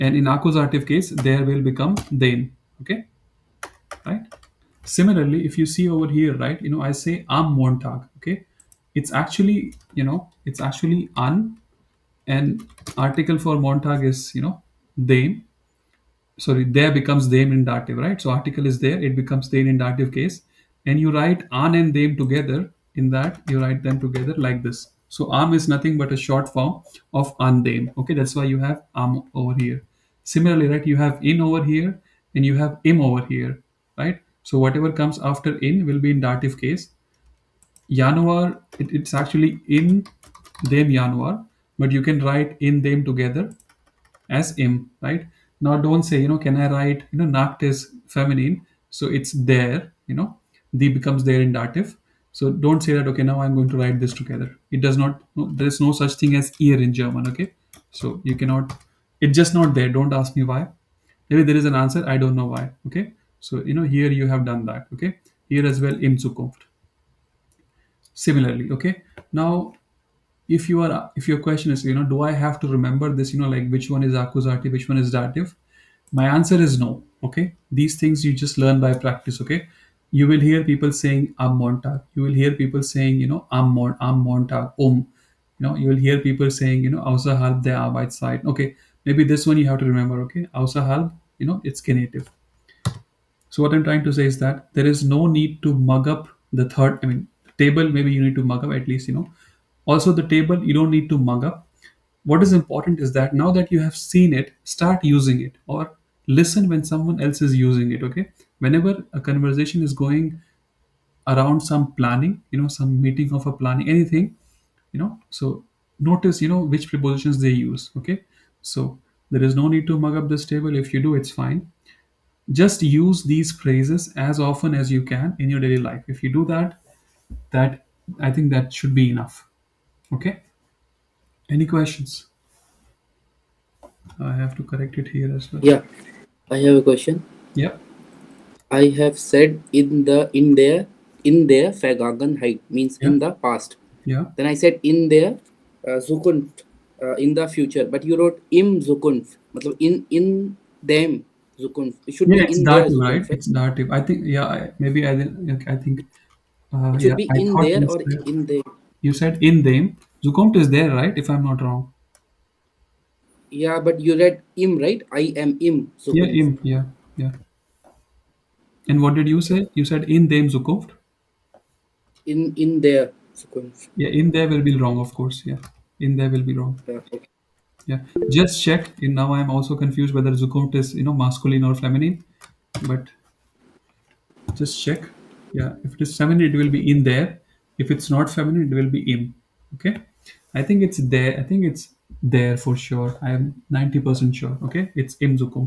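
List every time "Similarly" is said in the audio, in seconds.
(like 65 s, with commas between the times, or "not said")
4 s, 30 s, 68 s.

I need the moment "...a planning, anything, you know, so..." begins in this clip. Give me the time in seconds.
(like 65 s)
113 s.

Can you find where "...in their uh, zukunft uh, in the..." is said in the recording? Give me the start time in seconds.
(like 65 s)
144 s.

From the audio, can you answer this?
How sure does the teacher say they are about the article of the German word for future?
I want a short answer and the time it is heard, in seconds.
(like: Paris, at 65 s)
90 percent, at 193 s.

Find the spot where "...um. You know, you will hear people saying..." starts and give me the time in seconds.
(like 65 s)
84 s.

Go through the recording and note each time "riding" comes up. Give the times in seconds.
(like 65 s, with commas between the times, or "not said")
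not said.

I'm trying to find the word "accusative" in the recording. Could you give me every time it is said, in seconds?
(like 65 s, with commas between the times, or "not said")
0 s, 74 s.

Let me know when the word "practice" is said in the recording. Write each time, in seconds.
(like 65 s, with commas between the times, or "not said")
78 s.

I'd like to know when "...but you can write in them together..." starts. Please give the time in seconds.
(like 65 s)
41 s.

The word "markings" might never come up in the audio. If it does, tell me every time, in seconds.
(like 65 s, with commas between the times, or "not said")
not said.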